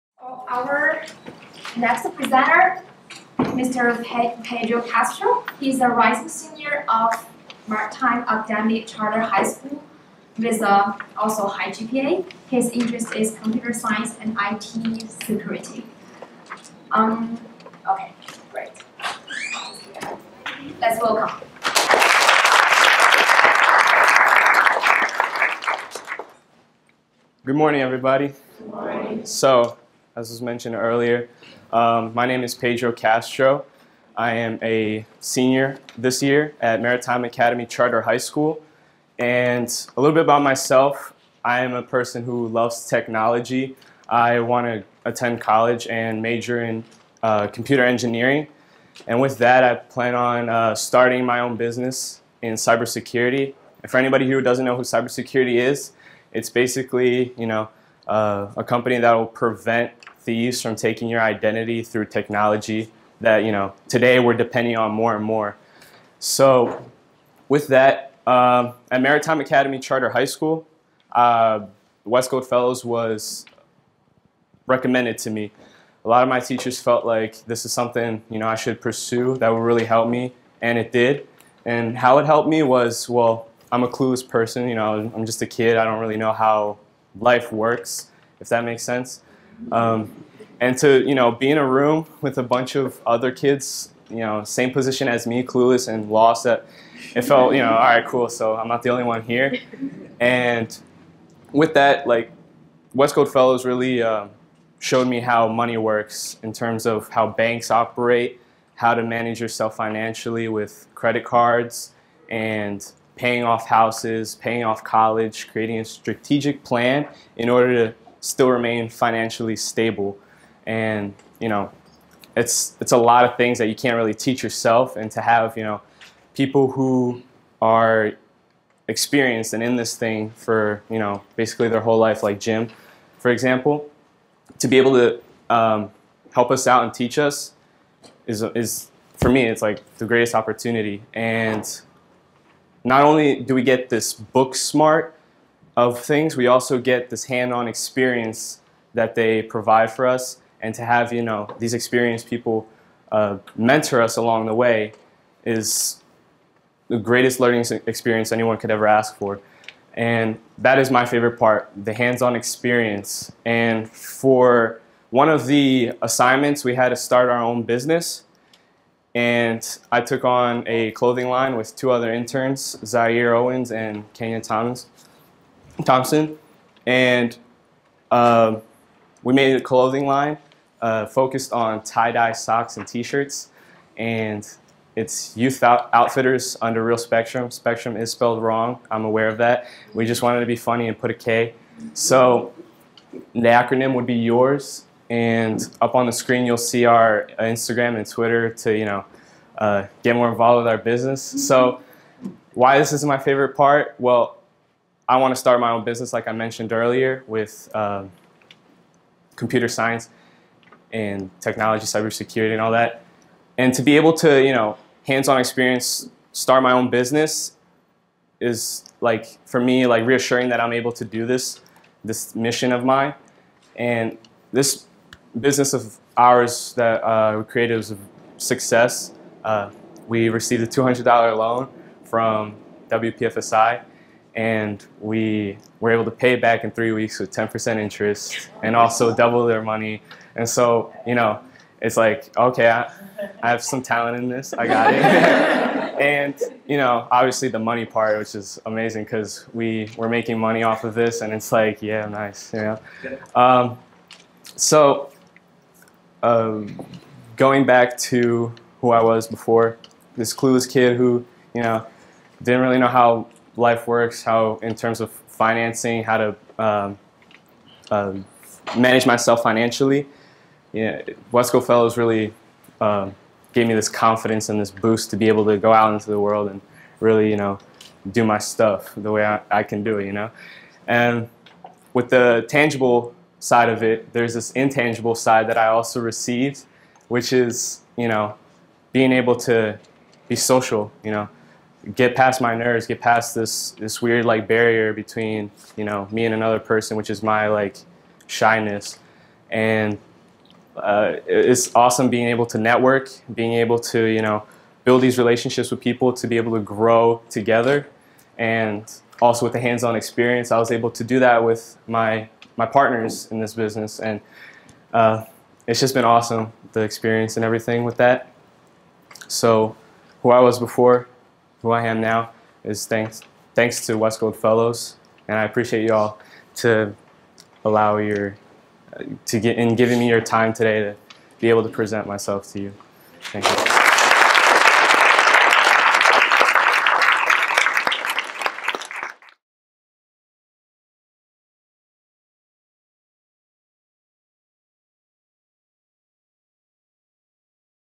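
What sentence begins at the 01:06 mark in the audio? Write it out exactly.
So, with that, uh, at Maritime Academy Charter High School, uh, Coast Fellows was recommended to me.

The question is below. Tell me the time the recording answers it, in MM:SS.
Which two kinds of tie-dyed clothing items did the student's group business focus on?
03:02.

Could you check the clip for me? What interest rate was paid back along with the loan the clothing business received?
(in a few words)
10%.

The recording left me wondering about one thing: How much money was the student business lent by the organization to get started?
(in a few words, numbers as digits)
$200.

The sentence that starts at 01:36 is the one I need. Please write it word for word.
That it felt you know all right, cool.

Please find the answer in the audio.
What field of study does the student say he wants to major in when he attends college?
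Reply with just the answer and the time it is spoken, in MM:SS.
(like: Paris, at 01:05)
Computer engineering, at 00:47.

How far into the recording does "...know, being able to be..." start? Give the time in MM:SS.
04:48.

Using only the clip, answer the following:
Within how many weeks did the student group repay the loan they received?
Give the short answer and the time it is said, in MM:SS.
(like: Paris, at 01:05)
3 weeks, at 03:56.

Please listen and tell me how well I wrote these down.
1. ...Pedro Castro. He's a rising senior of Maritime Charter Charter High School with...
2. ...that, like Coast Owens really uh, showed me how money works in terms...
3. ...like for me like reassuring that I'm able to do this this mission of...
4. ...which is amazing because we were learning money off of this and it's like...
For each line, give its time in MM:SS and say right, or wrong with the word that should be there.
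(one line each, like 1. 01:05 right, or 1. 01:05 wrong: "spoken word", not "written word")
1. 00:04 wrong: "Academy", not "Charter"
2. 01:41 wrong: "Fellows", not "Owens"
3. 03:39 right
4. 04:08 wrong: "making", not "learning".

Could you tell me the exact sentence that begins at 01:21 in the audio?
And how it helped me was well, I'm a clueless person.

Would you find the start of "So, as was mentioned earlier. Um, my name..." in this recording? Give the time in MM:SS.
00:29.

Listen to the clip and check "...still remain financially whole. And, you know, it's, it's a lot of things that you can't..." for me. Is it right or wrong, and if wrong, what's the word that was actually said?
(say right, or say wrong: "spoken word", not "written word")
wrong: "stable", not "whole".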